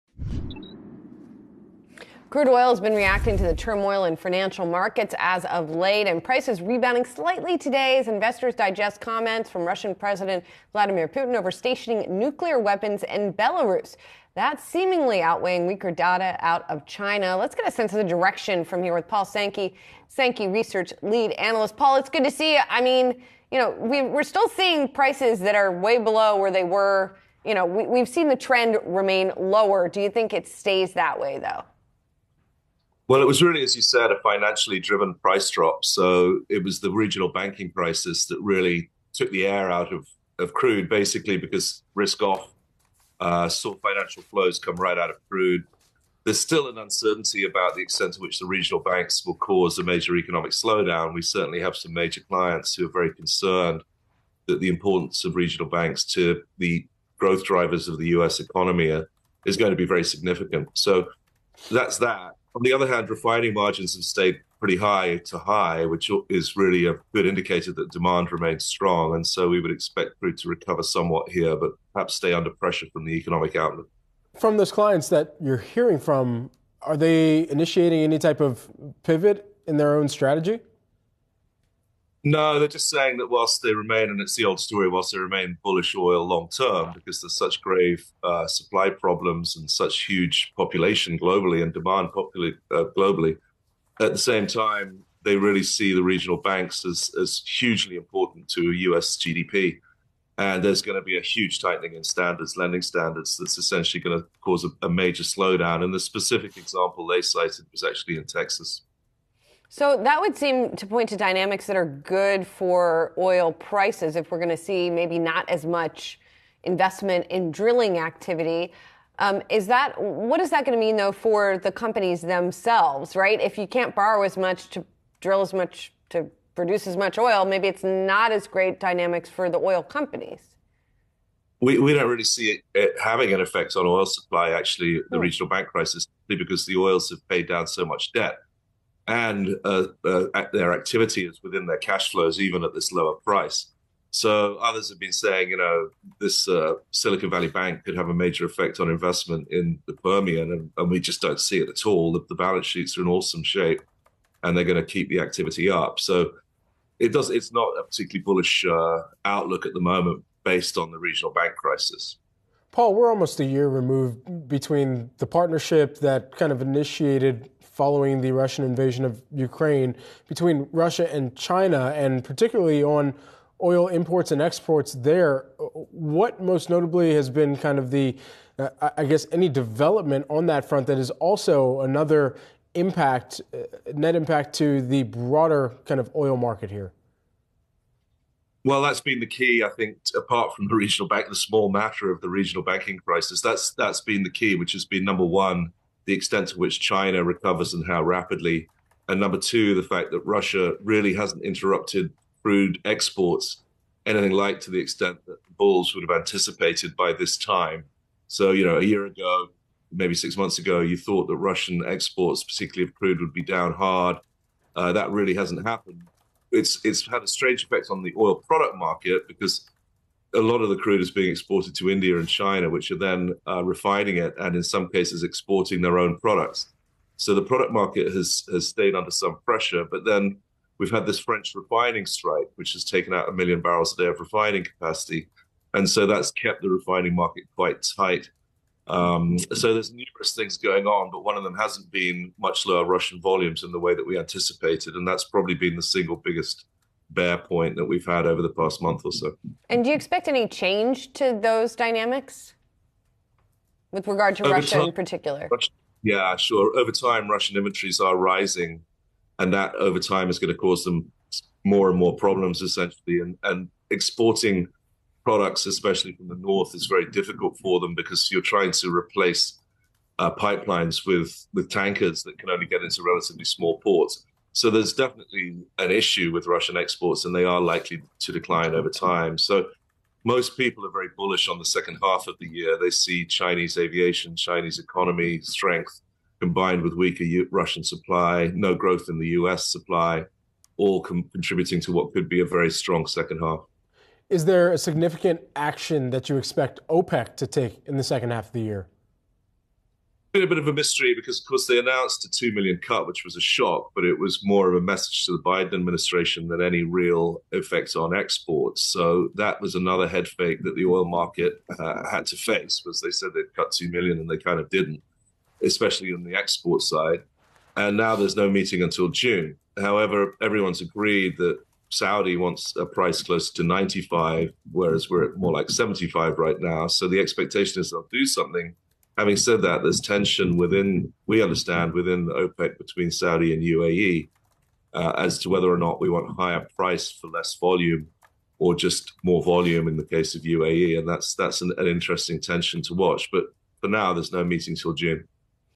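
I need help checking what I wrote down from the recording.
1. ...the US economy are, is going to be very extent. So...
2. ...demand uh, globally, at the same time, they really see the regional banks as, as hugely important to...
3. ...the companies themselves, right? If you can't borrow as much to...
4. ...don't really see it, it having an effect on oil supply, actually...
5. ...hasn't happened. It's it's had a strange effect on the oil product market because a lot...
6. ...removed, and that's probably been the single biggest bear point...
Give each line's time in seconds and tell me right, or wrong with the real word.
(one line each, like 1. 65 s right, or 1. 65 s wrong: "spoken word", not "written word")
1. 57 s wrong: "significant", not "extent"
2. 91 s right
3. 121 s right
4. 131 s right
5. 215 s right
6. 244 s wrong: "anticipated", not "removed".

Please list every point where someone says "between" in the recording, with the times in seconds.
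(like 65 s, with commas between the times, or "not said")
164 s, 170 s, 332 s.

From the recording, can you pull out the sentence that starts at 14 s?
That's seemingly outweighing weaker data out of China.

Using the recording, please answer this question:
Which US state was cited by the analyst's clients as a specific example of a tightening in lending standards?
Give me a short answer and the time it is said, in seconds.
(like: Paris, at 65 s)
Texas, at 108 s.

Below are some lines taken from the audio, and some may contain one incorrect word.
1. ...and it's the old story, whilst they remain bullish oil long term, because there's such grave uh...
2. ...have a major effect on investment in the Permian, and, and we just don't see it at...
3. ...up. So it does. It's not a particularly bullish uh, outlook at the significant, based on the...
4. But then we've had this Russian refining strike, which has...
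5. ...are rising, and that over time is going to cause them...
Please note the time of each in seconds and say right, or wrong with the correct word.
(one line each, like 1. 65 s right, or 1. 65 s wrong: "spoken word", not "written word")
1. 84 s right
2. 147 s right
3. 155 s wrong: "moment", not "significant"
4. 229 s wrong: "French", not "Russian"
5. 257 s right.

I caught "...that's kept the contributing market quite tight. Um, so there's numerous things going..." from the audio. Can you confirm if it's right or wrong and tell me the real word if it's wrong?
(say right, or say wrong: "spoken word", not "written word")
wrong: "refining", not "contributing".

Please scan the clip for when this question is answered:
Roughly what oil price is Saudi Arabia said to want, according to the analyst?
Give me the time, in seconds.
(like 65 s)
323 s.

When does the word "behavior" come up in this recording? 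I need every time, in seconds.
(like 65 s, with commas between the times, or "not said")
not said.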